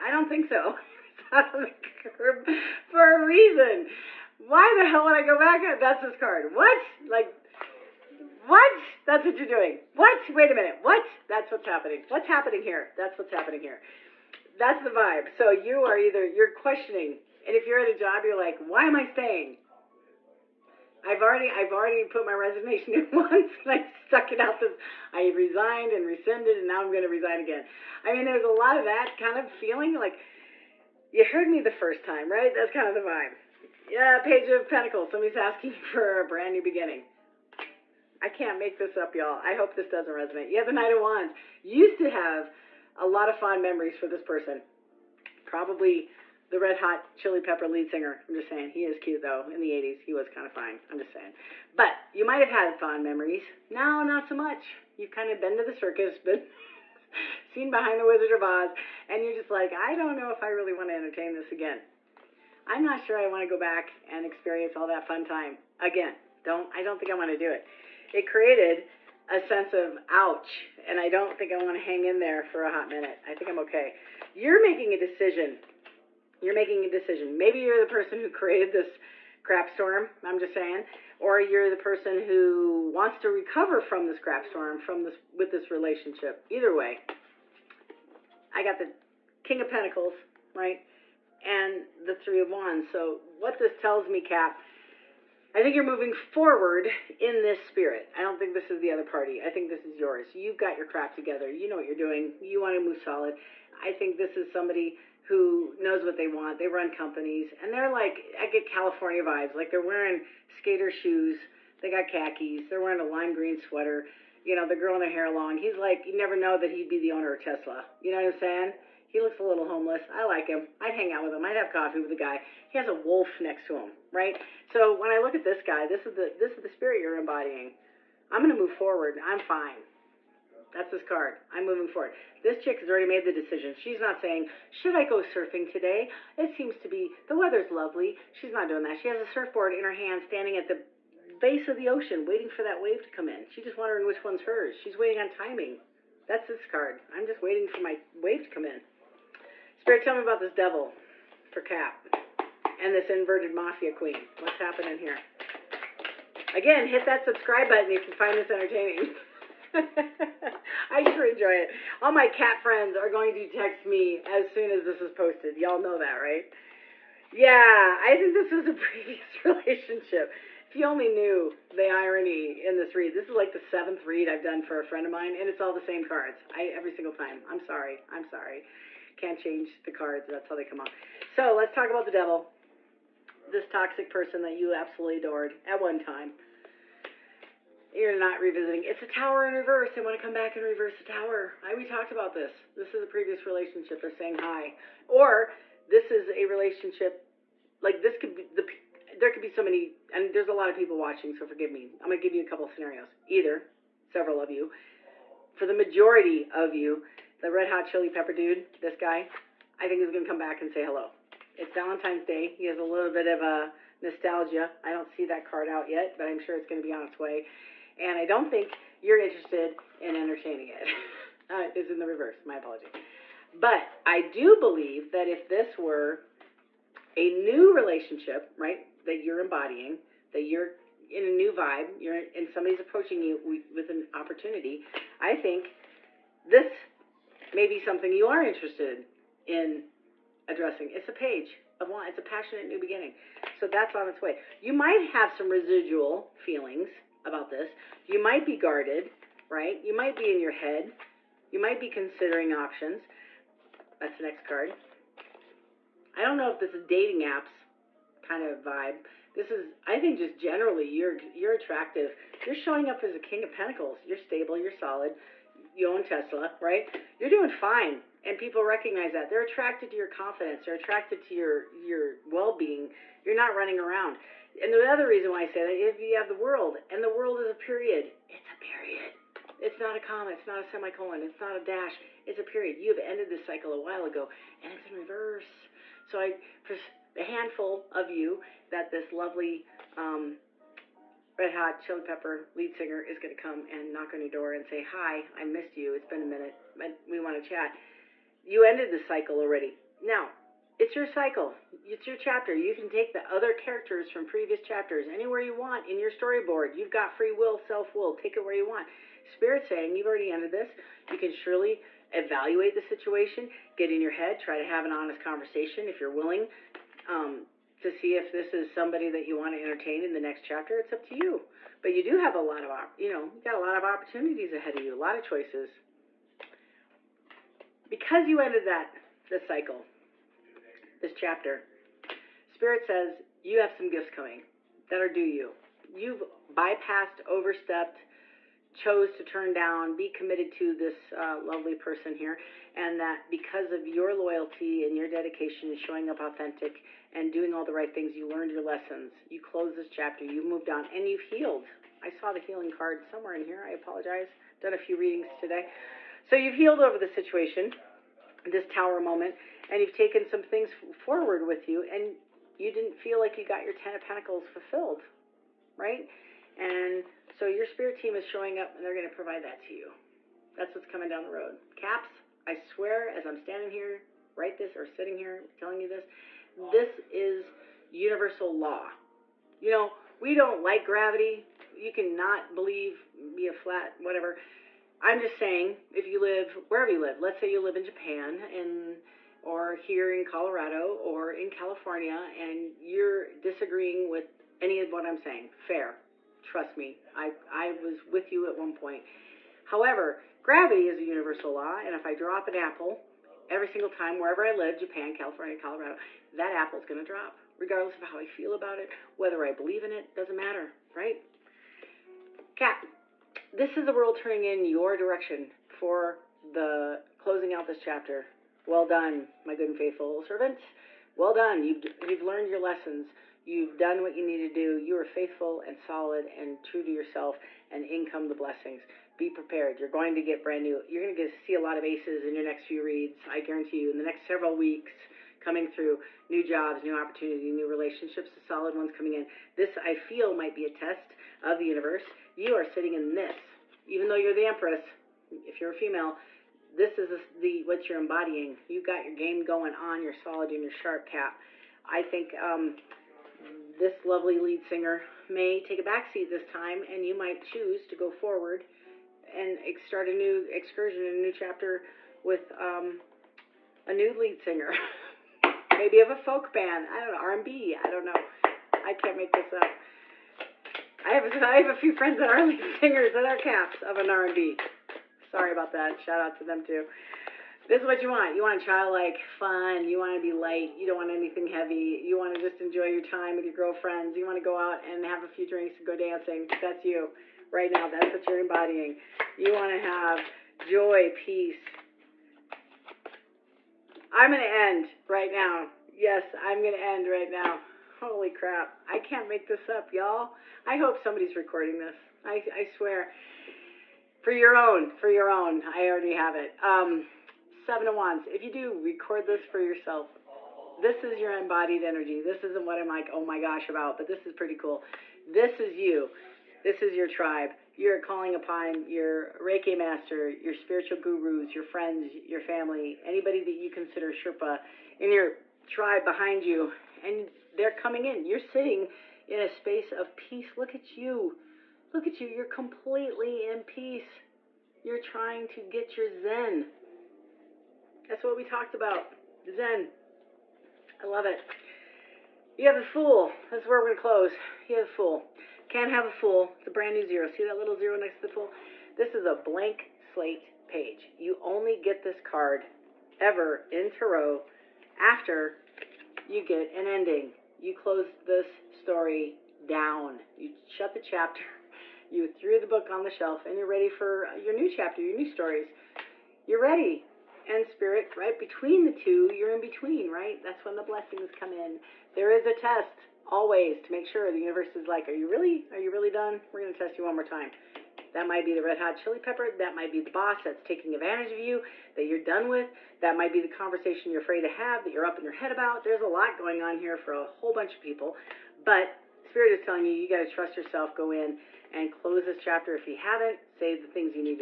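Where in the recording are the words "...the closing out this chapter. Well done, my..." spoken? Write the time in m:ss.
6:56.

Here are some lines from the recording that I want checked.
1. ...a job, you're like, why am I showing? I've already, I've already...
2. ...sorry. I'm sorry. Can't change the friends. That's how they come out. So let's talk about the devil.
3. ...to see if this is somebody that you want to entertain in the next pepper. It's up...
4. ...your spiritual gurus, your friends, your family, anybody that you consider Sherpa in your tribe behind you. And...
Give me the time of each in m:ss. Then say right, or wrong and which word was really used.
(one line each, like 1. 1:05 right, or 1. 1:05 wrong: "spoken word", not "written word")
1. 0:17 wrong: "staying", not "showing"
2. 2:57 wrong: "cards", not "friends"
3. 5:17 wrong: "chapter", not "pepper"
4. 8:40 right.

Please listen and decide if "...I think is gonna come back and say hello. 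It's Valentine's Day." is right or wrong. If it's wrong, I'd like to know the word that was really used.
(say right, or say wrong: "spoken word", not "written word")
right.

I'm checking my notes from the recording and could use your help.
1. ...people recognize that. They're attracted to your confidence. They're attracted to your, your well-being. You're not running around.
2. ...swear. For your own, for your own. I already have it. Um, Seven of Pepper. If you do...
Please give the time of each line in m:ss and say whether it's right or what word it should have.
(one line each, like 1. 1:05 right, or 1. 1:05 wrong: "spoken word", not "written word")
1. 4:28 right
2. 8:22 wrong: "Wands", not "Pepper".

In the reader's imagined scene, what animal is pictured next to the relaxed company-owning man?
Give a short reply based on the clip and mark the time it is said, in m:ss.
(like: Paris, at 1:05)
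A wolf, at 2:02.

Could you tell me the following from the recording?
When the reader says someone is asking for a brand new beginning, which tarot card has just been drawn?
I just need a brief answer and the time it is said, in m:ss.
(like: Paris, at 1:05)
Page of Pentacles, at 0:34.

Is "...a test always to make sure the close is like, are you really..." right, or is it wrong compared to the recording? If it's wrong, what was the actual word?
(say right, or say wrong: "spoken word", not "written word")
wrong: "universe", not "close".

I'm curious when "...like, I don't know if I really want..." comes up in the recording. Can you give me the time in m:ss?
0:59.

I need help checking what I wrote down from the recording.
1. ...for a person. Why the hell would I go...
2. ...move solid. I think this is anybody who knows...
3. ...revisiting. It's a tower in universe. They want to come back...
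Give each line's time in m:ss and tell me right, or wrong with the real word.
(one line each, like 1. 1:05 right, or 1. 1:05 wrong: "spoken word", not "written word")
1. 0:02 wrong: "reason", not "person"
2. 1:42 wrong: "somebody", not "anybody"
3. 3:08 wrong: "reverse", not "universe".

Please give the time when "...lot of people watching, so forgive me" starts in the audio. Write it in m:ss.
3:20.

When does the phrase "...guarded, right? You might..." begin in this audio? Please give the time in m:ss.
4:08.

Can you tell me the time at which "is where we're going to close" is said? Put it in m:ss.
9:03.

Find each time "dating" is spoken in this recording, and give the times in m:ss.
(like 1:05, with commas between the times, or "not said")
4:16.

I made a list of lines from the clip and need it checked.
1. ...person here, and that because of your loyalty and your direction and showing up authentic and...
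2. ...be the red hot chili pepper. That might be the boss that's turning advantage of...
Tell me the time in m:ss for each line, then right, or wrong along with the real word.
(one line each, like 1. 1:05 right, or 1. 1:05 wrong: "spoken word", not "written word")
1. 5:41 wrong: "dedication", not "direction"
2. 9:38 wrong: "taking", not "turning".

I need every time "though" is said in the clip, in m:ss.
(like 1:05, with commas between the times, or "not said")
0:49, 7:24.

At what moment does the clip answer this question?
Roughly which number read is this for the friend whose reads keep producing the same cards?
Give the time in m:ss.
2:53.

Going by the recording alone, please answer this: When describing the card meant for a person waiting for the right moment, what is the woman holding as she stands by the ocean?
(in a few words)
A surfboard.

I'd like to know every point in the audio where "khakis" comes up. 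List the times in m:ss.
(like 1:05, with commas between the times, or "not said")
1:52.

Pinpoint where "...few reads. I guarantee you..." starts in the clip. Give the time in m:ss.
7:12.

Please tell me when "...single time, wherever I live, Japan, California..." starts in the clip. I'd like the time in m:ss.
6:43.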